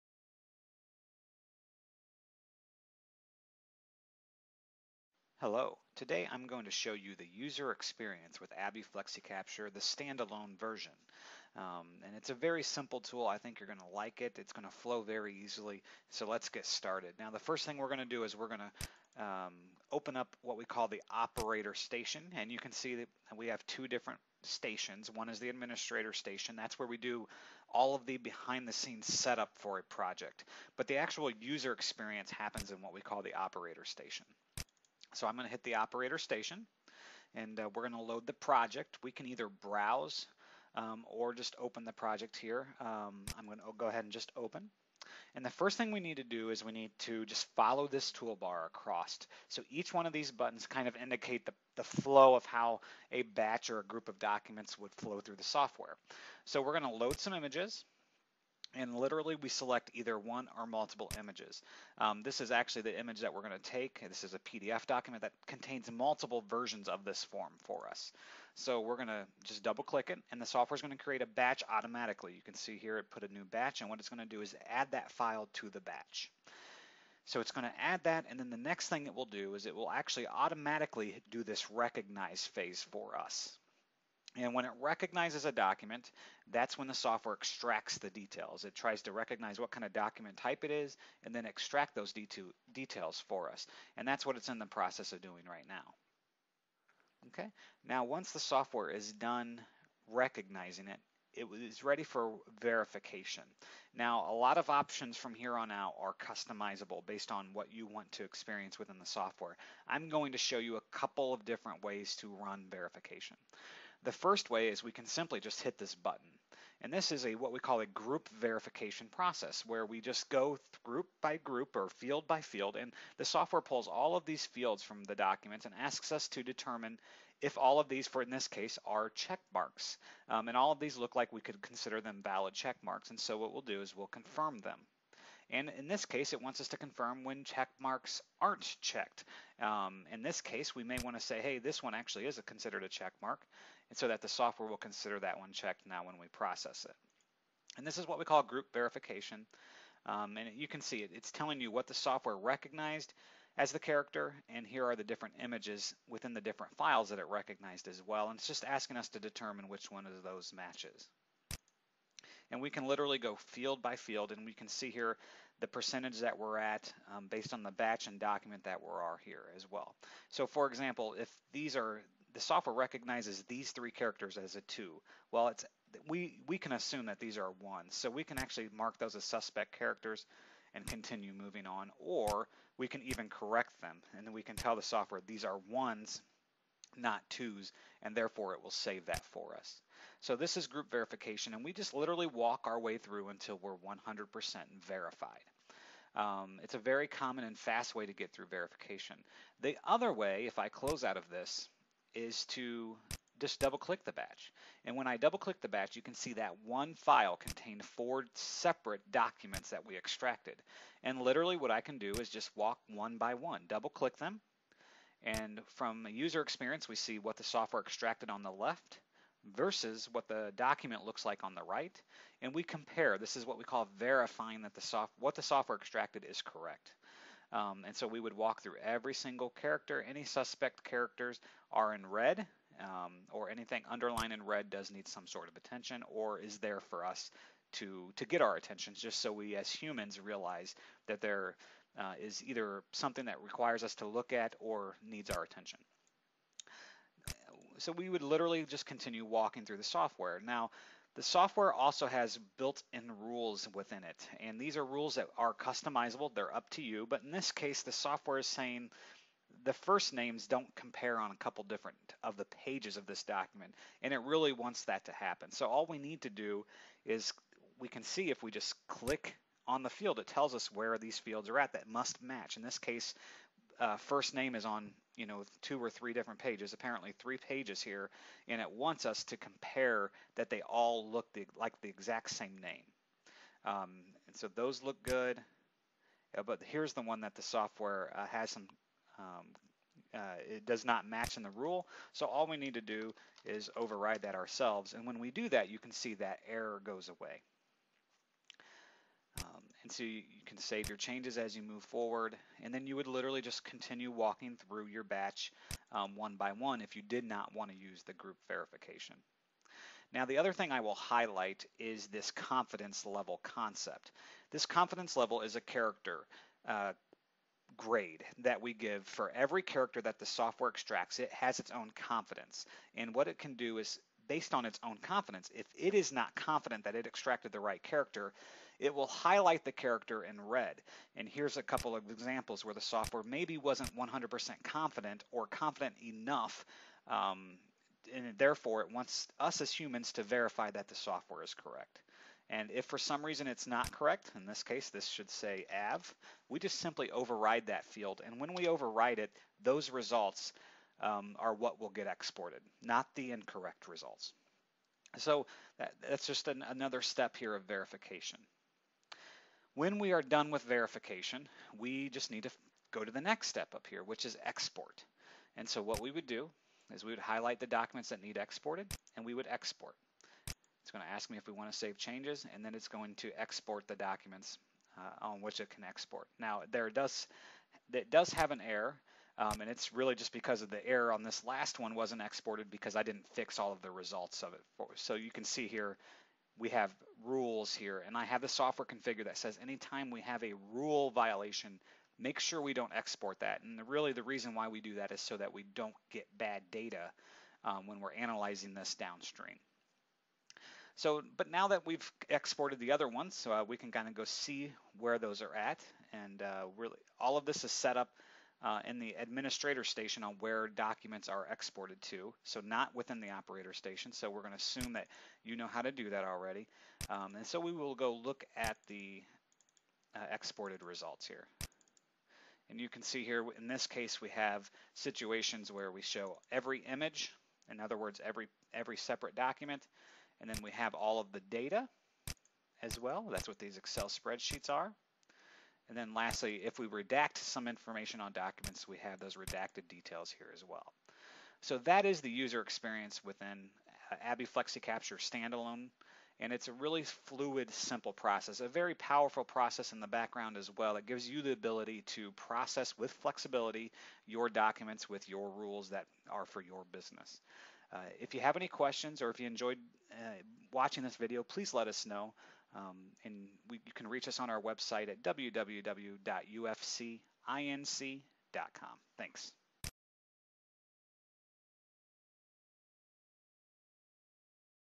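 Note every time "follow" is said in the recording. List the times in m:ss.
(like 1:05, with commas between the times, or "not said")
0:47.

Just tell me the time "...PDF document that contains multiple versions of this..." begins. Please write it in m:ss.
1:04.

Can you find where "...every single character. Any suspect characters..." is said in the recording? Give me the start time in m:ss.
3:48.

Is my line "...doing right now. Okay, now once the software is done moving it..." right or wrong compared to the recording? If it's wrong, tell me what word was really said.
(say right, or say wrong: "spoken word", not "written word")
wrong: "recognizing", not "moving".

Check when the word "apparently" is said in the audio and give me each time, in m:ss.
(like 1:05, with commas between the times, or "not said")
4:36.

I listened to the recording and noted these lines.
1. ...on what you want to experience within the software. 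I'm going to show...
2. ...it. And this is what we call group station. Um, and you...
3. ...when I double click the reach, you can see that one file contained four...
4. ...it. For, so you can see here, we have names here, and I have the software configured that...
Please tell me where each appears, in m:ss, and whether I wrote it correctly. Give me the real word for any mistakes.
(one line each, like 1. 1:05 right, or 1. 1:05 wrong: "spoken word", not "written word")
1. 1:47 right
2. 2:26 wrong: "verification", not "station"
3. 3:24 wrong: "batch", not "reach"
4. 6:24 wrong: "rules", not "names".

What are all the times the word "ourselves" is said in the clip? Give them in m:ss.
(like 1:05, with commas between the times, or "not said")
4:54.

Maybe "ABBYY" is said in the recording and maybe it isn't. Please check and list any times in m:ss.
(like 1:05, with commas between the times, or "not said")
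0:08, 7:24.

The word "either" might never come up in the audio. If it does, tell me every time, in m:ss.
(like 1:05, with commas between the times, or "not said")
0:39, 0:59, 4:02.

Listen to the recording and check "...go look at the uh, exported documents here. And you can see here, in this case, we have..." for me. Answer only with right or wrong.
wrong.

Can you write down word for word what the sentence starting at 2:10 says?
Um, and all of these look like we could consider them valid check marks.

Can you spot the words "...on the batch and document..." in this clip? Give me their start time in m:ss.
2:47.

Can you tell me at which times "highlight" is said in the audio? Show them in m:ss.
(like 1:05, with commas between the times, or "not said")
5:10, 5:29, 6:07.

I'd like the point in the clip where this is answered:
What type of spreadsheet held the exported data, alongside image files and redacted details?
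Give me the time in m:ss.
7:13.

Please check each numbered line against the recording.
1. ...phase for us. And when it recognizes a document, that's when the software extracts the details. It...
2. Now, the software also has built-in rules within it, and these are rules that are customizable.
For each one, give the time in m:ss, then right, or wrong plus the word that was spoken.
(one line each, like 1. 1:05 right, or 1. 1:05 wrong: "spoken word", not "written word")
1. 1:22 right
2. 4:10 right.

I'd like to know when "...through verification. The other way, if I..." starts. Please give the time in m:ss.
3:18.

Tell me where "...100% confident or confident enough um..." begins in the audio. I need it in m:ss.
5:33.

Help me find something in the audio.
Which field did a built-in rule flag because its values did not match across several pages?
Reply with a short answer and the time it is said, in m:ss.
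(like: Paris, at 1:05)
First name, at 4:19.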